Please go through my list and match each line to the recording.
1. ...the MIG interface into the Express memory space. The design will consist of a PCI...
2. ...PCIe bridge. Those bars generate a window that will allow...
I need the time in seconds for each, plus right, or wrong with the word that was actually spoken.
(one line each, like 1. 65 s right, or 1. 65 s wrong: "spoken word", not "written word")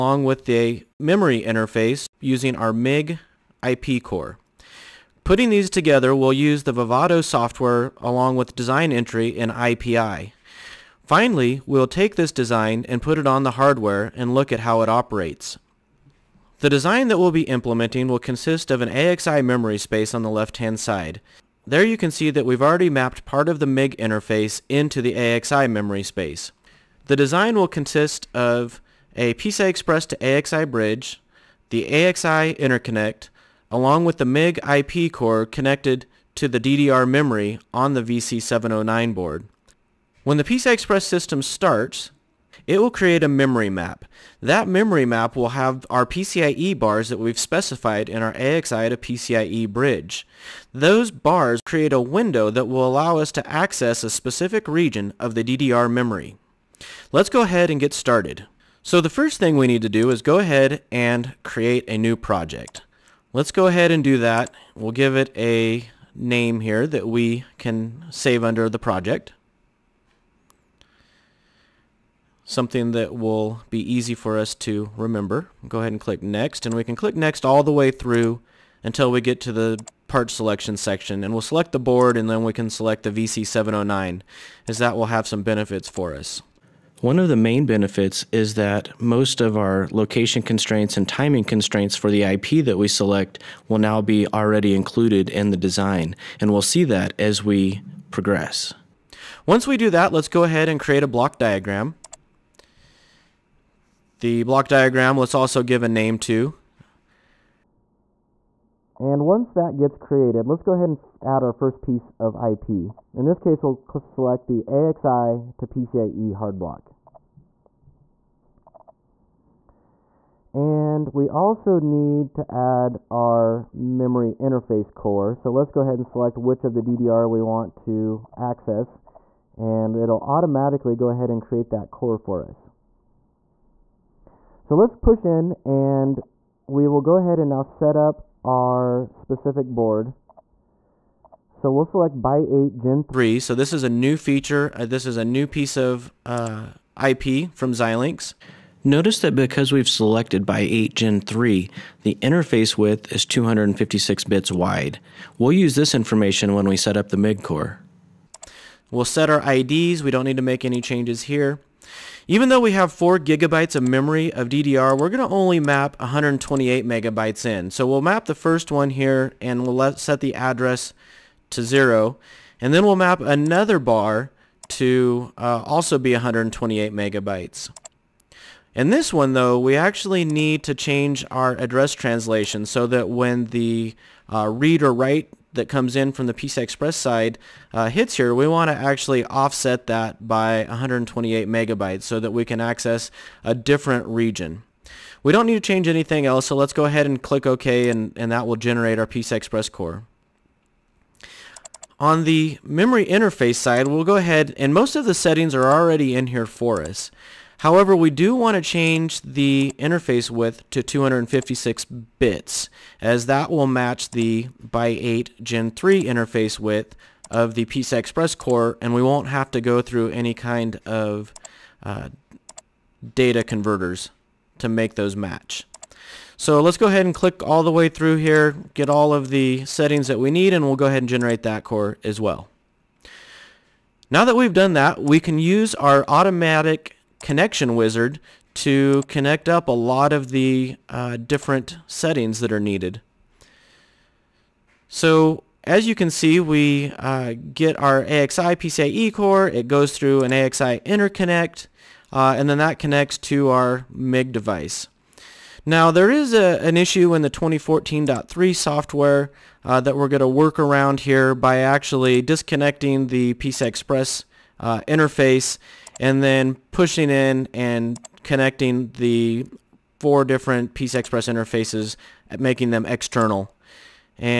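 1. 23 s wrong: "AXI", not "Express"
2. 48 s wrong: "create", not "generate".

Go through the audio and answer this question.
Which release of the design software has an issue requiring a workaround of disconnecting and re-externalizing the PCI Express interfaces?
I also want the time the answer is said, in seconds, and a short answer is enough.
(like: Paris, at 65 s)
2014.3, at 257 s.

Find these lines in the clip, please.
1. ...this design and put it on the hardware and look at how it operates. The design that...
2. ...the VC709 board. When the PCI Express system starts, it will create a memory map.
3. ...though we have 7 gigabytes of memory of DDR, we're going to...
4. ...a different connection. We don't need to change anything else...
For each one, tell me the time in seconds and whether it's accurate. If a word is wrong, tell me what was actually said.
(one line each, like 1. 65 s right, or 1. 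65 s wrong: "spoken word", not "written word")
1. 12 s right
2. 37 s right
3. 162 s wrong: "4", not "7"
4. 193 s wrong: "region", not "connection".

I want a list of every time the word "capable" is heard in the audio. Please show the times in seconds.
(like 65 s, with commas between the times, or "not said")
not said.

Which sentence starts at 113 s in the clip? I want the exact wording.
In this case, we'll select the AXI to PCIe hard block.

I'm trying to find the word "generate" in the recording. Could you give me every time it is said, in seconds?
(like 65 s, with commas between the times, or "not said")
198 s, 231 s.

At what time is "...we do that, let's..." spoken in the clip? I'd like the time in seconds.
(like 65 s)
99 s.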